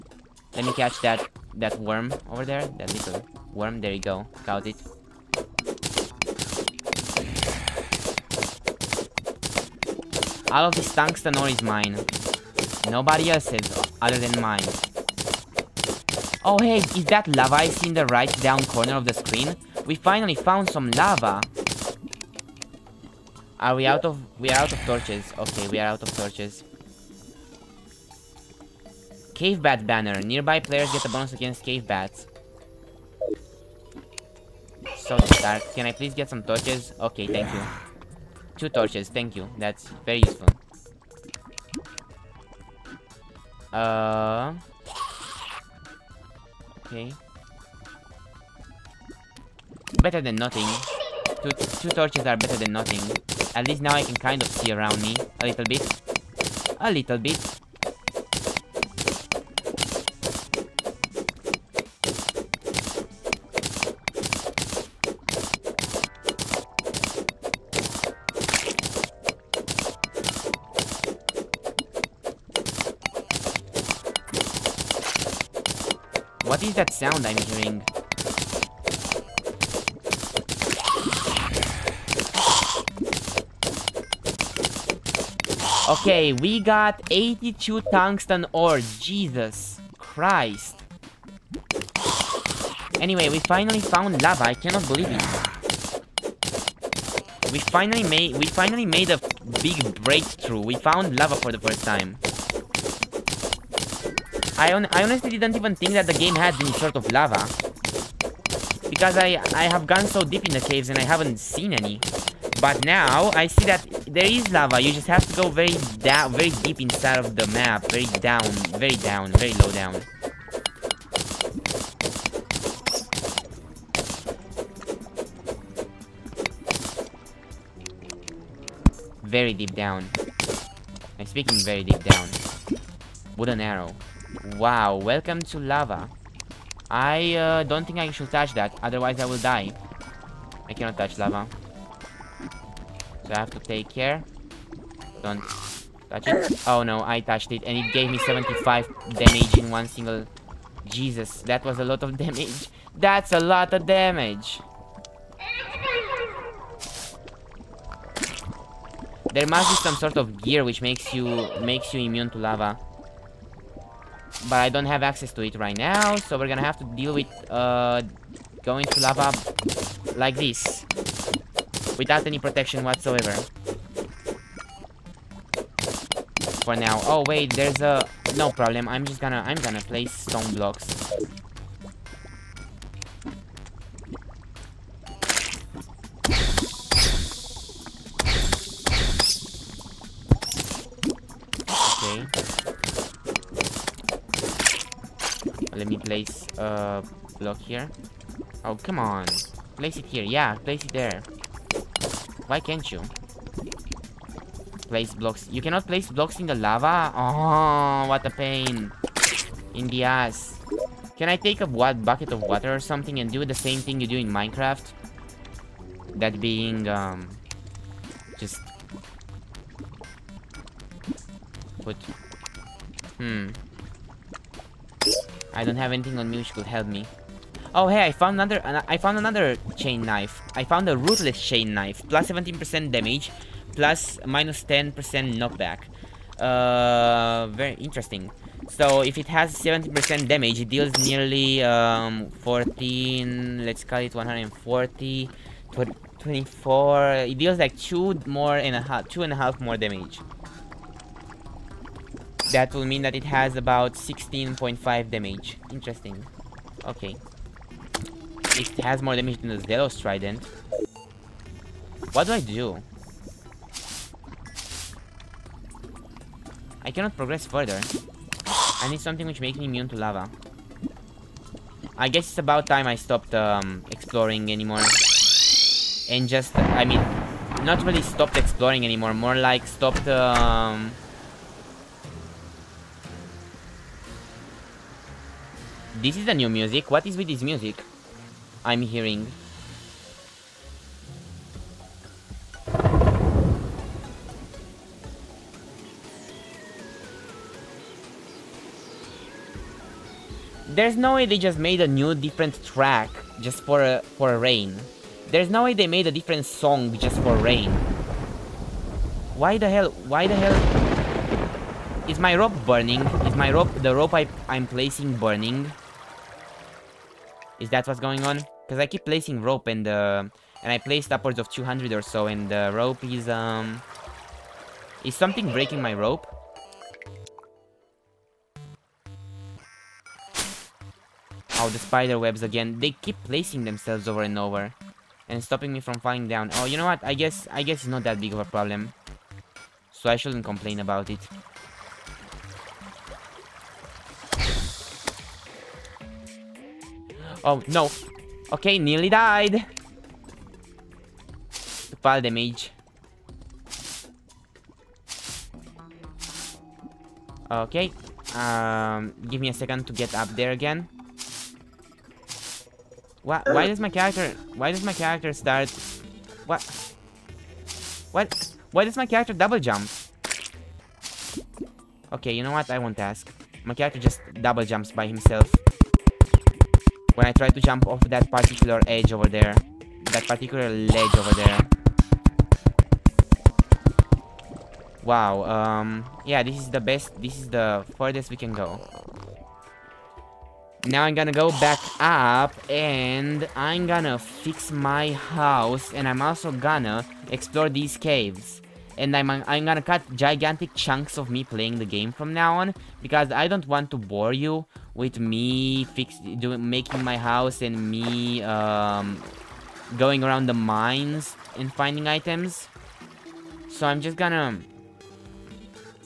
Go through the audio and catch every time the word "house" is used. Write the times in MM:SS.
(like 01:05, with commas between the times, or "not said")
06:35, 06:47.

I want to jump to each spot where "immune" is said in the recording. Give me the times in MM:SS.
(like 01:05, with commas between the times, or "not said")
02:42, 04:29.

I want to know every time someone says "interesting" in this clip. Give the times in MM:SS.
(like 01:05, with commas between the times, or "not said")
03:57, 04:15.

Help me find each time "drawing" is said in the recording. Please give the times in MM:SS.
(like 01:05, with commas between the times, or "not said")
not said.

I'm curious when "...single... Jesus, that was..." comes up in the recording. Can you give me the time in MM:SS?
02:29.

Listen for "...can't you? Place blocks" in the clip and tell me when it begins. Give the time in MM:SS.
03:22.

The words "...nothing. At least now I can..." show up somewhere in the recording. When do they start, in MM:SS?
00:52.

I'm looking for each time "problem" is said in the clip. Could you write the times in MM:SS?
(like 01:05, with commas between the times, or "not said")
02:58, 05:38.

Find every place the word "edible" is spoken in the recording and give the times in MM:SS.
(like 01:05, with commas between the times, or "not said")
not said.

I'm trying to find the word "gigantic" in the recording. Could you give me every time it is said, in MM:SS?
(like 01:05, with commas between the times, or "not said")
06:40.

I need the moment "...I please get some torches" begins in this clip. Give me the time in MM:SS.
00:35.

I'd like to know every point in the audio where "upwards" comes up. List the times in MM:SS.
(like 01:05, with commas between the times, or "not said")
05:21.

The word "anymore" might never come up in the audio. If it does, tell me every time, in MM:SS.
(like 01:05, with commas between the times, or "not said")
04:34, 04:38.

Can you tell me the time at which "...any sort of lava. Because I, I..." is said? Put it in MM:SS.
01:46.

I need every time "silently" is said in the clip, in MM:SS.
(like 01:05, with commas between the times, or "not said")
not said.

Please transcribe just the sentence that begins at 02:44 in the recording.
But I don't have access to it right now, so we're gonna have to deal with uh, going to lava like this.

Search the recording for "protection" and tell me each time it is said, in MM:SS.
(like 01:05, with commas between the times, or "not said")
02:52.